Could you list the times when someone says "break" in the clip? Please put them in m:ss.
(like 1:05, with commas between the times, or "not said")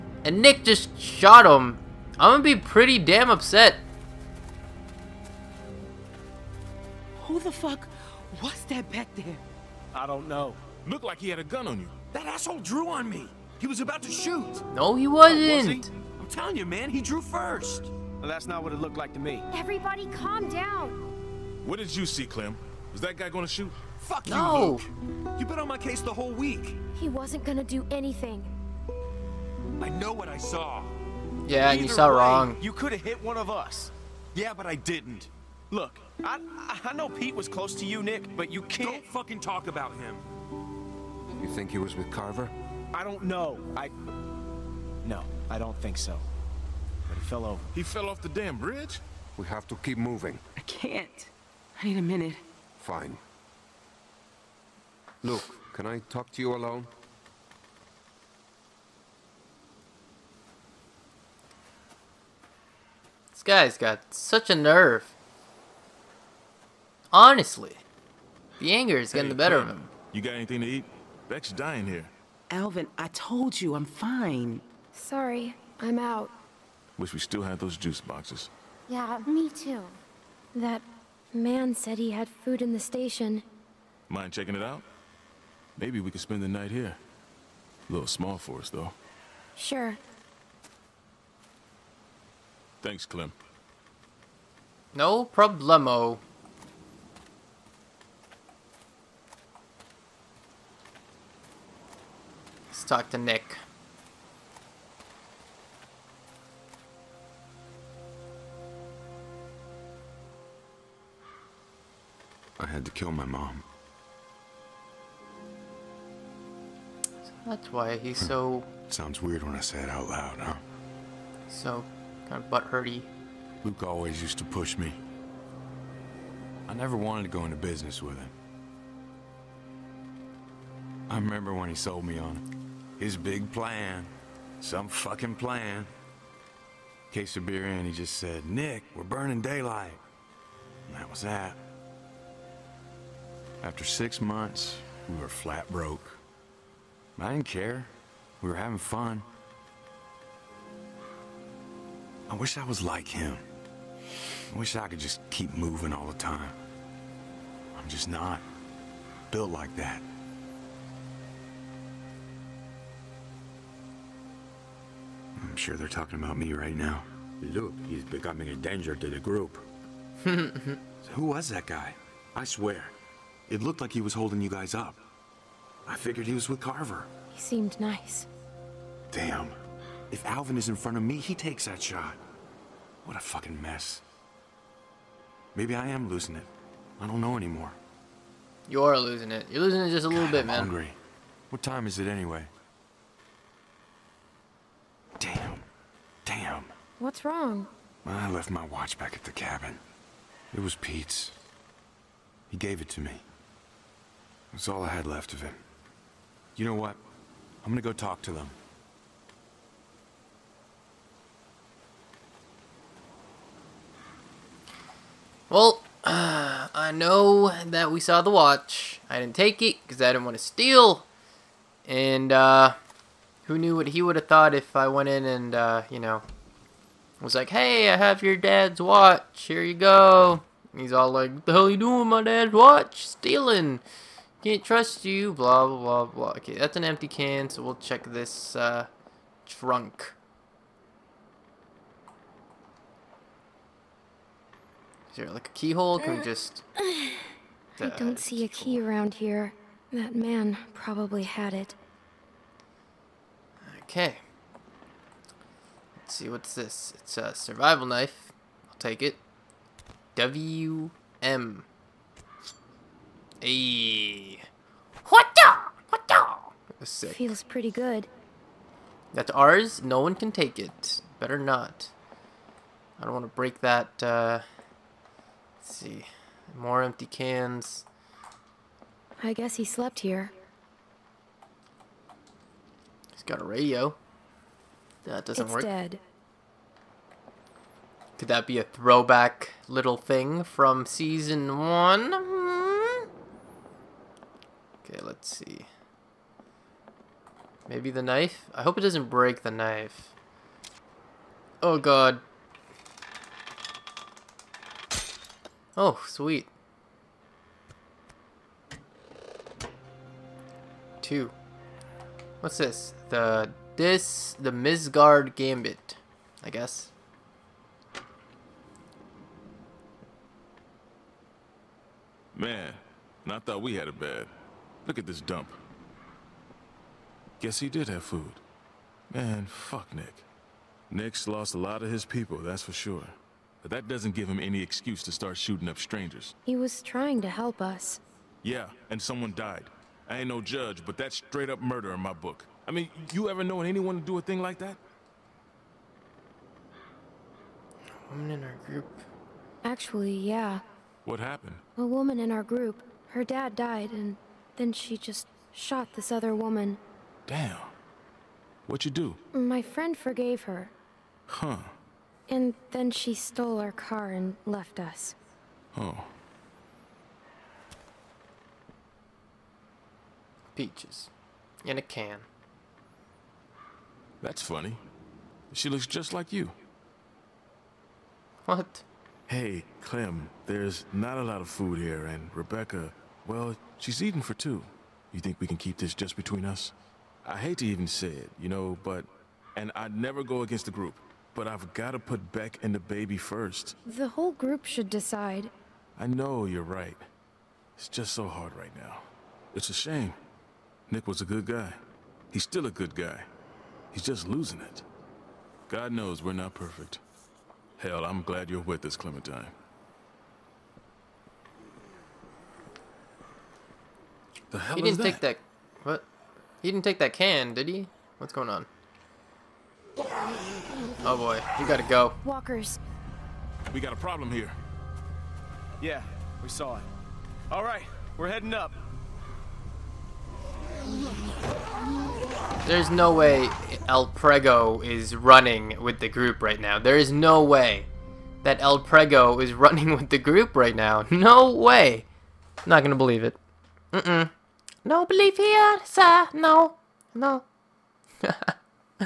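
4:33, 4:59.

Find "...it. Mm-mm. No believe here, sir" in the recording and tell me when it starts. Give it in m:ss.
7:23.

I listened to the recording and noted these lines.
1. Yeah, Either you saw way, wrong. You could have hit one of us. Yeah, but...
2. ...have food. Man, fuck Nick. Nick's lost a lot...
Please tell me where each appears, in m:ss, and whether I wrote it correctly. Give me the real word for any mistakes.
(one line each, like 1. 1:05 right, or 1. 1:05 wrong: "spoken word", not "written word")
1. 0:31 right
2. 5:27 right.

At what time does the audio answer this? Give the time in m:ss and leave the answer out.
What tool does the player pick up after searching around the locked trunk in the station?
4:16.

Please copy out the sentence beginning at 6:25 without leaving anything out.
You think we can keep this just between us?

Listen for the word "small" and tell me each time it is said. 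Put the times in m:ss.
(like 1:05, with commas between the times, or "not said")
1:28.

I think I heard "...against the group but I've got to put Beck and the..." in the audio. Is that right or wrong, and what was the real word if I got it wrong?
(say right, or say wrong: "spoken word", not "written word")
right.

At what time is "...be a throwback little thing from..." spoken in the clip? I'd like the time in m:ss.
4:48.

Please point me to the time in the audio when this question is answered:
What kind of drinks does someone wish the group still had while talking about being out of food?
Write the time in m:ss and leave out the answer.
1:17.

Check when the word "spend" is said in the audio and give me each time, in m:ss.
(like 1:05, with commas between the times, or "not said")
1:26.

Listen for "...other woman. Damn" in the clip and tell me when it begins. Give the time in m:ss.
5:56.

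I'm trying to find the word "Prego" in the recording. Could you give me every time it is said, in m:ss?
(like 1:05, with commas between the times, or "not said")
7:14, 7:18.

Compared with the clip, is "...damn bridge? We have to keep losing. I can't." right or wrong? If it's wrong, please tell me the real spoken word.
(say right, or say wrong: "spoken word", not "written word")
wrong: "moving", not "losing".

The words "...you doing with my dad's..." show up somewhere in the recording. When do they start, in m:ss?
3:51.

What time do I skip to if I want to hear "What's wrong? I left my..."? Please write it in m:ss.
3:16.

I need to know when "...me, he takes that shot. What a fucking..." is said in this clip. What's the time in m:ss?
3:01.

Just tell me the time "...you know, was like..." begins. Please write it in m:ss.
3:45.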